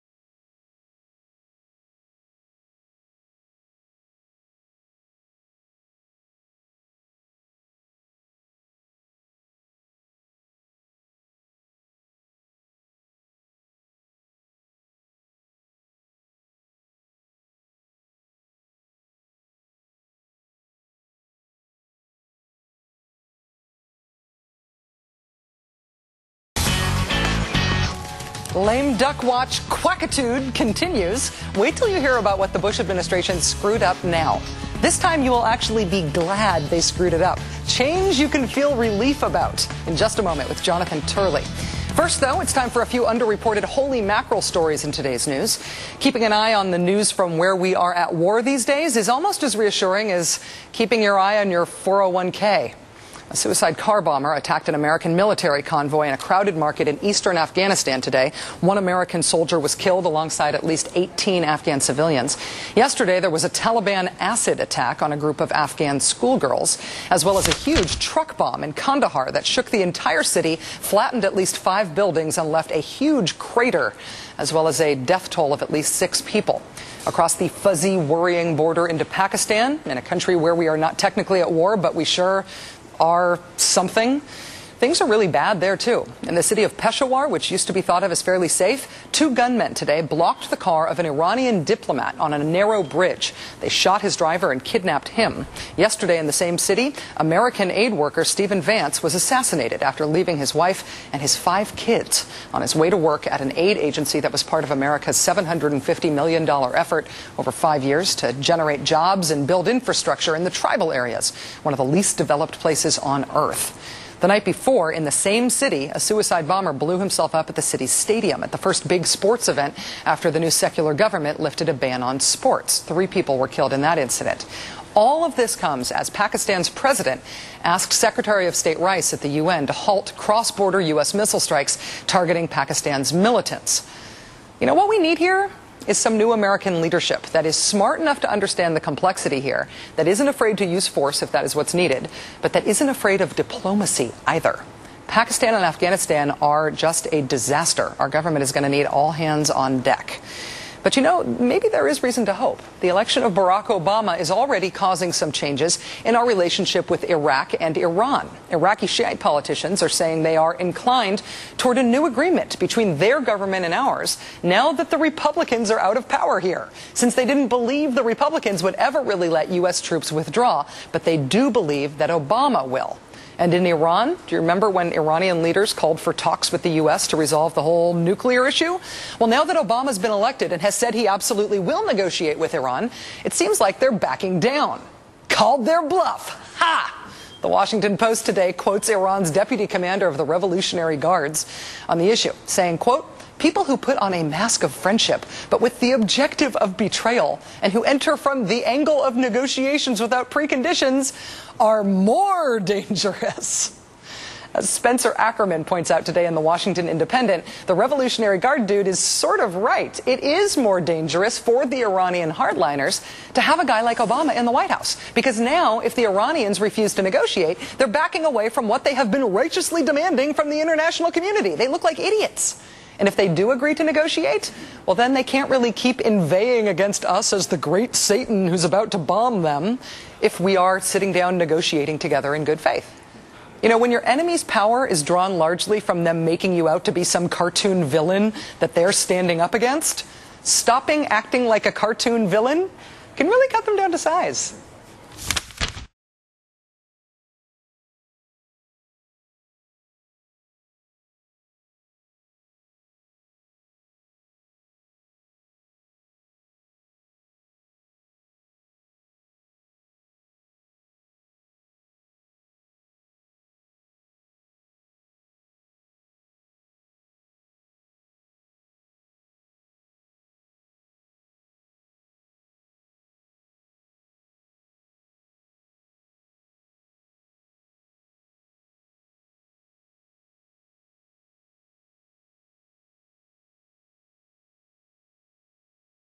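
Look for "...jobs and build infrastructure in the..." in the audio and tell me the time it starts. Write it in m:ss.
1:48.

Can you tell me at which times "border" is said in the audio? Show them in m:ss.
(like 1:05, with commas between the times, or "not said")
1:18, 2:10.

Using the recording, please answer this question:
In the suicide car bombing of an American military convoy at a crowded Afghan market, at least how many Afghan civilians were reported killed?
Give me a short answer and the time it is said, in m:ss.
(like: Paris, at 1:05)
18, at 1:00.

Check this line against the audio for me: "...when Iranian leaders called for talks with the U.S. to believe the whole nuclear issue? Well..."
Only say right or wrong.
wrong.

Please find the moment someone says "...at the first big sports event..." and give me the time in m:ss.
1:58.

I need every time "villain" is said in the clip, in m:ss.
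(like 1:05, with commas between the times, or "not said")
3:57, 4:02.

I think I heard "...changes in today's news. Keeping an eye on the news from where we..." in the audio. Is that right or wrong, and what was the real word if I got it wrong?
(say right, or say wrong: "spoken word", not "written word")
wrong: "stories", not "changes".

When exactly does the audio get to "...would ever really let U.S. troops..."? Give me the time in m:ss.
2:48.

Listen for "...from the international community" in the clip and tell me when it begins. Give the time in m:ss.
3:40.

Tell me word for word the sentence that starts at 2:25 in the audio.
Pakistan and Afghanistan are just a disaster.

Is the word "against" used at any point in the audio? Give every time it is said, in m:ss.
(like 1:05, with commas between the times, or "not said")
3:46, 3:59.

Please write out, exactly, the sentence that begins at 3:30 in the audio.
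It is more dangerous for the Iranian hardliners to have a guy like Obama in the White House.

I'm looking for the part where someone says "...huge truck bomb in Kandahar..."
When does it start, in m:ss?
1:07.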